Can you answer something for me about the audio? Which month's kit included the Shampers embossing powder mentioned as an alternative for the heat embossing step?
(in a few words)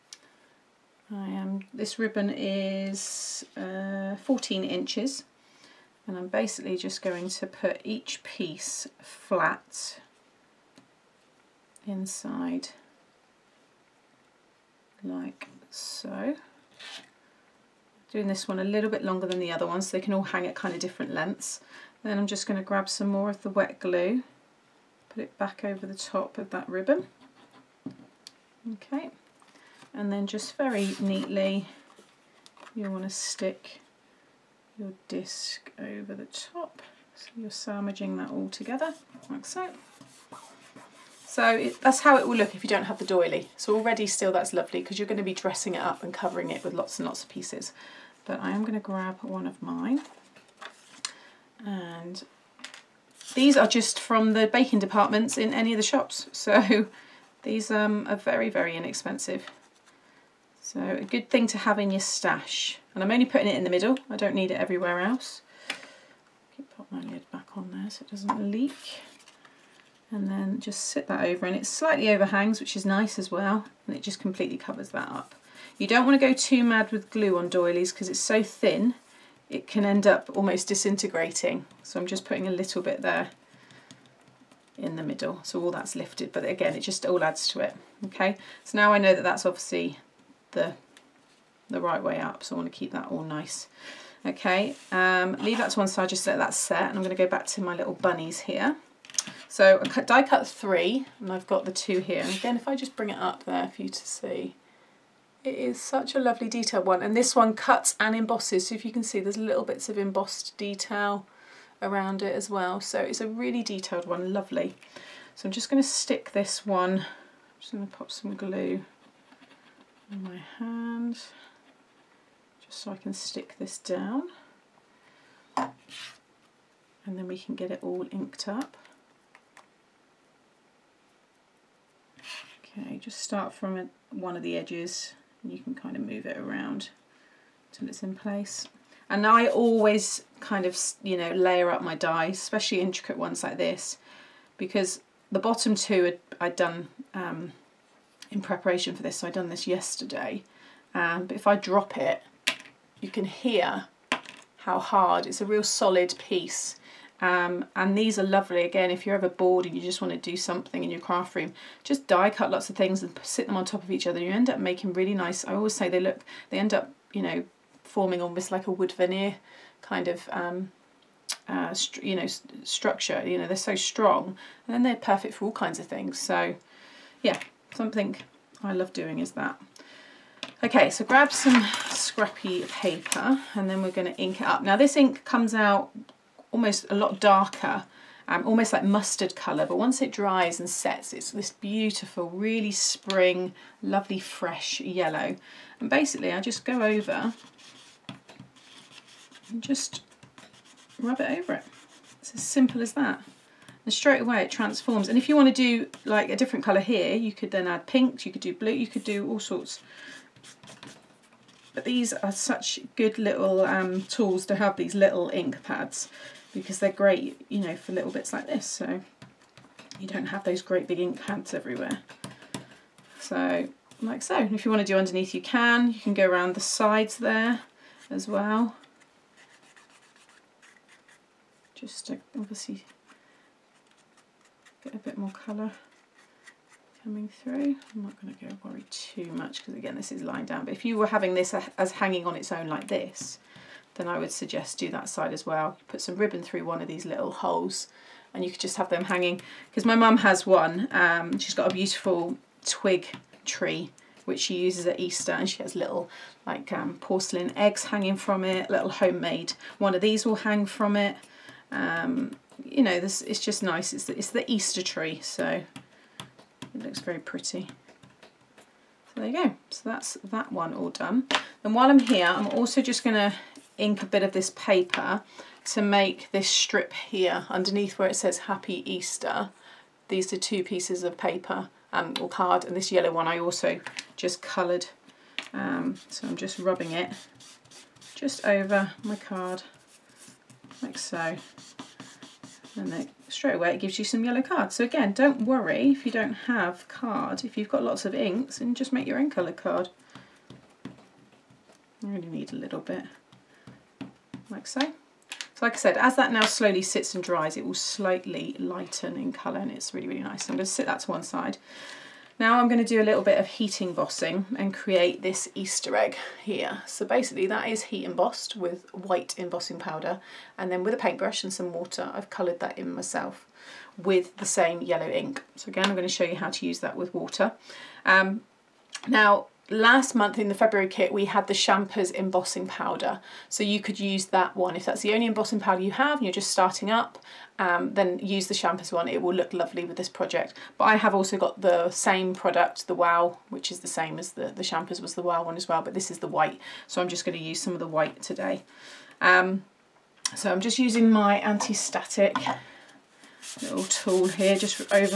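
February.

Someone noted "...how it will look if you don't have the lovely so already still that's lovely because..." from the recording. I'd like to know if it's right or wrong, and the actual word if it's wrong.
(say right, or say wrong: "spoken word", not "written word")
wrong: "doily", not "lovely".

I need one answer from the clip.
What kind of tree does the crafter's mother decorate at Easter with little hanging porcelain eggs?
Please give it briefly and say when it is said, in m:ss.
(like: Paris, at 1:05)
twig tree, at 4:12.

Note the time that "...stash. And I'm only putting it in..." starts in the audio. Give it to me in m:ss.
1:02.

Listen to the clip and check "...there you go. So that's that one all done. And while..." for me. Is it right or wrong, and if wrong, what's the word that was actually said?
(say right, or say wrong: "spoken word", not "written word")
right.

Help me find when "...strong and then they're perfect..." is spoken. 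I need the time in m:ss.
2:53.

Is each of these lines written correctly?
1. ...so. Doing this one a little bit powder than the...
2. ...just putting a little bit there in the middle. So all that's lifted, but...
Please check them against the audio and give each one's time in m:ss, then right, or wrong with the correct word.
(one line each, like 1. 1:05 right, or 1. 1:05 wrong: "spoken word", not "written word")
1. 0:15 wrong: "longer", not "powder"
2. 1:22 right.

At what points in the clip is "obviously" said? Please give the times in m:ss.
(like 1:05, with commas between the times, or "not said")
1:29, 3:52.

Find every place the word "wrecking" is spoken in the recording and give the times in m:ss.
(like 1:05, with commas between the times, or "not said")
not said.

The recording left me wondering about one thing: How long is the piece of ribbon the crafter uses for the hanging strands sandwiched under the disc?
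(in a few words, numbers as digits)
14 inches.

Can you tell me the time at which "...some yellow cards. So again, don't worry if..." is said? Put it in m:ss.
4:54.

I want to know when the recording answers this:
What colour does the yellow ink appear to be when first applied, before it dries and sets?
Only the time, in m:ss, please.
3:08.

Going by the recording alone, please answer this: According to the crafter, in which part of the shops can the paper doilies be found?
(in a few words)
baking departments.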